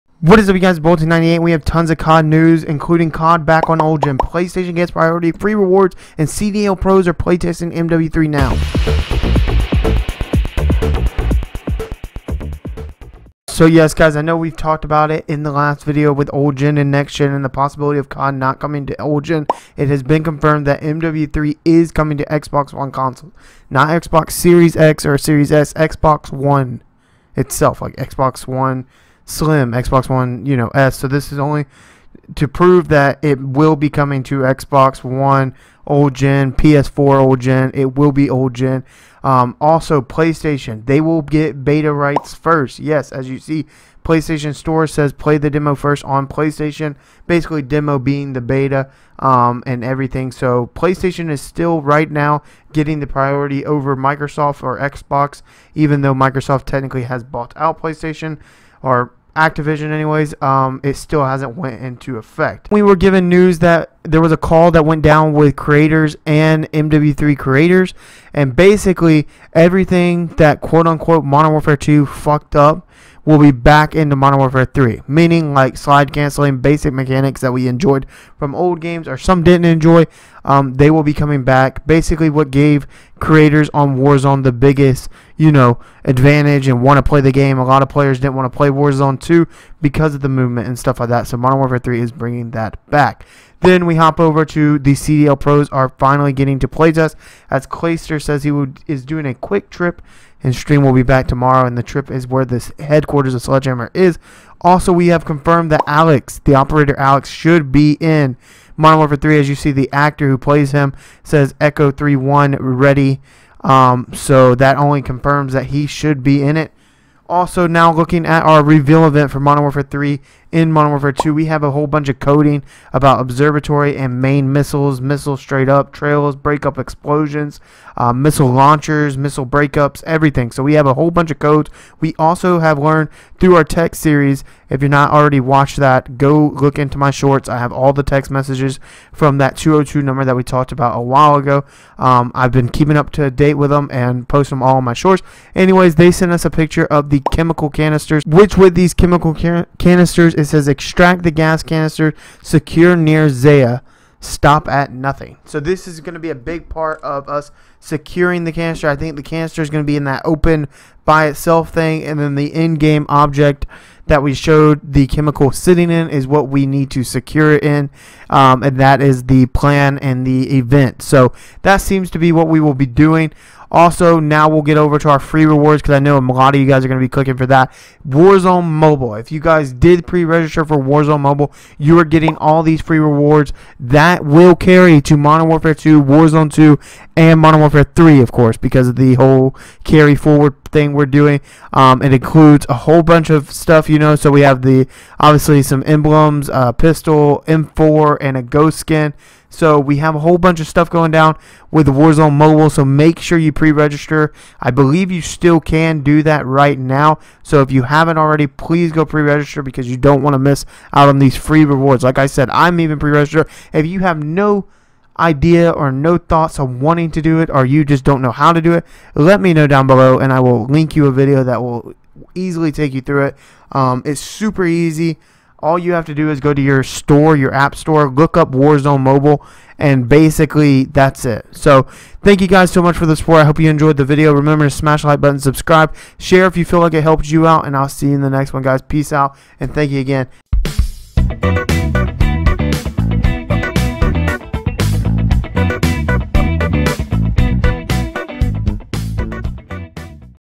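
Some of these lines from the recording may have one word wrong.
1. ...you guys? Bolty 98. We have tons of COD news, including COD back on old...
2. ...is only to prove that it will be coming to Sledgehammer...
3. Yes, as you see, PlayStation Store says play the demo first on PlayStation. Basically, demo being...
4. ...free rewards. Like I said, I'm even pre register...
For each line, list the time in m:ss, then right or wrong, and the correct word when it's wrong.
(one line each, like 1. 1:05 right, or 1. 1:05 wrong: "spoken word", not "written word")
1. 0:00 right
2. 0:31 wrong: "Xbox", not "Sledgehammer"
3. 0:42 right
4. 3:31 right.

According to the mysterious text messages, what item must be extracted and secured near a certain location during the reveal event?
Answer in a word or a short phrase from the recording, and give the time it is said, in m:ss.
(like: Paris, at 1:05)
gas canister, at 2:31.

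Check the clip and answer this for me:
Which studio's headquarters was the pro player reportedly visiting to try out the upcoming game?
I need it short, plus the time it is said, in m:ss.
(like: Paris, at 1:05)
Sledgehammer, at 1:43.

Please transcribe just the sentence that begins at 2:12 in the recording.
We also have learned through our tech series.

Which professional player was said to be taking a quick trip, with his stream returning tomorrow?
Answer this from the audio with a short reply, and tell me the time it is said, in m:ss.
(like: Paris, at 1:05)
Clayster, at 1:37.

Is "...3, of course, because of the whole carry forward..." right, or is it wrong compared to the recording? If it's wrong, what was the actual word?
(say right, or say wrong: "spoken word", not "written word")
right.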